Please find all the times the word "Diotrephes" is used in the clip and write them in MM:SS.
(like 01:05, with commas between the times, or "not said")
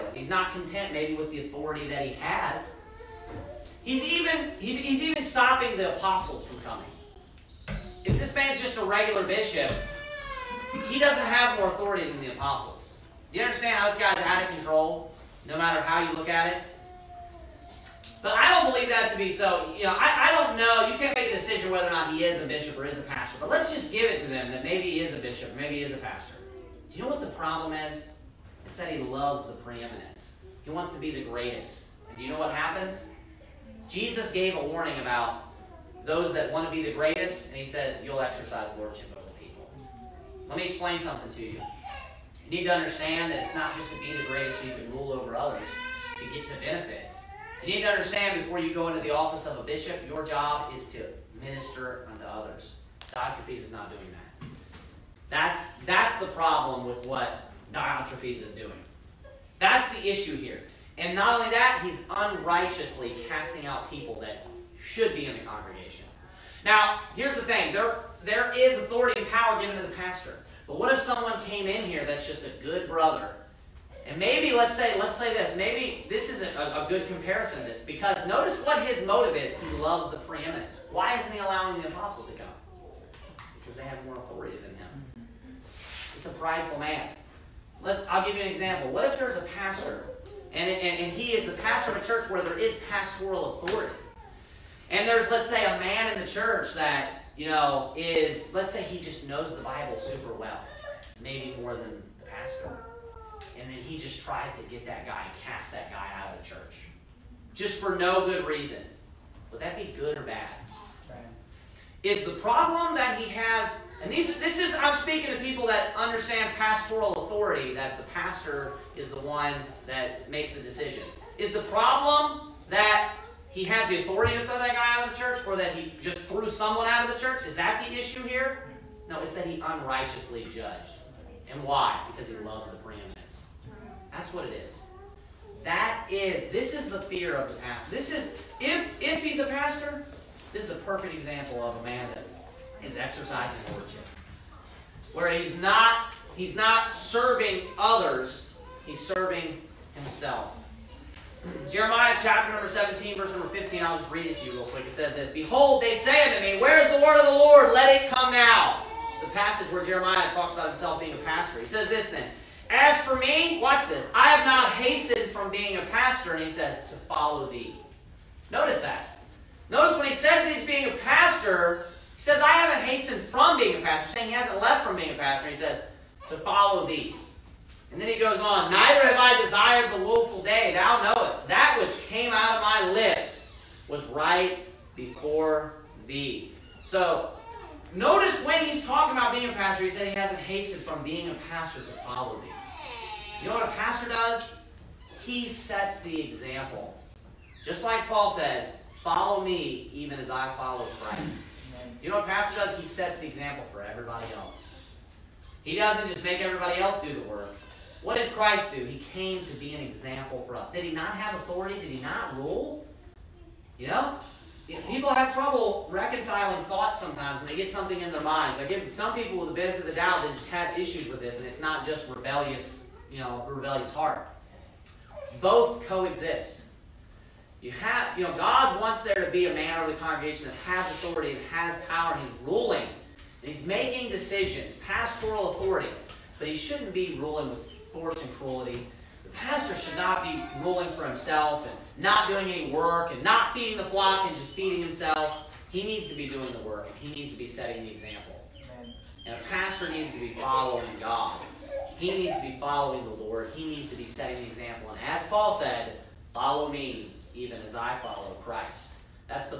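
00:53, 00:57.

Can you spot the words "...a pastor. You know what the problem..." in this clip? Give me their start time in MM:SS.
00:25.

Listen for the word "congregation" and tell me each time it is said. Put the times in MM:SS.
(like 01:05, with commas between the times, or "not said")
01:05, 03:49.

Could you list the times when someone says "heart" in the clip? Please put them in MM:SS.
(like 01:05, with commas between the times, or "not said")
03:43.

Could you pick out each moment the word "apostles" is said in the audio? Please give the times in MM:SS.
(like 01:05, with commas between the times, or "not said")
00:05, 00:12, 01:21.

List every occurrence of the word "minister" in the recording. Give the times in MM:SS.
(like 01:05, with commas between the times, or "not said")
00:51.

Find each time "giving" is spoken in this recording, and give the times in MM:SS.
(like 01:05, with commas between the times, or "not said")
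not said.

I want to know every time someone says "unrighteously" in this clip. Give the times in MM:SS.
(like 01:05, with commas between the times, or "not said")
01:02, 02:09.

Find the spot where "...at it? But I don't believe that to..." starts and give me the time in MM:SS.
00:16.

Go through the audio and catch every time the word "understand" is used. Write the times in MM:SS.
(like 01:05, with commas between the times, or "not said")
00:13, 00:42, 00:47, 01:55.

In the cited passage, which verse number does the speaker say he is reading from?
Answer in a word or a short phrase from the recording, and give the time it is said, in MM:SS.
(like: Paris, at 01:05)
15, at 02:33.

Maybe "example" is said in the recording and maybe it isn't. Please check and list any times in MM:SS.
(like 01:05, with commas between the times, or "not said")
01:28, 02:21, 03:16, 03:23, 03:29, 04:07, 04:14.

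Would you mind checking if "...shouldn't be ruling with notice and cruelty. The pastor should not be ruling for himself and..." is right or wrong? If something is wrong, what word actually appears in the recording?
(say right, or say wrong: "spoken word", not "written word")
wrong: "force", not "notice".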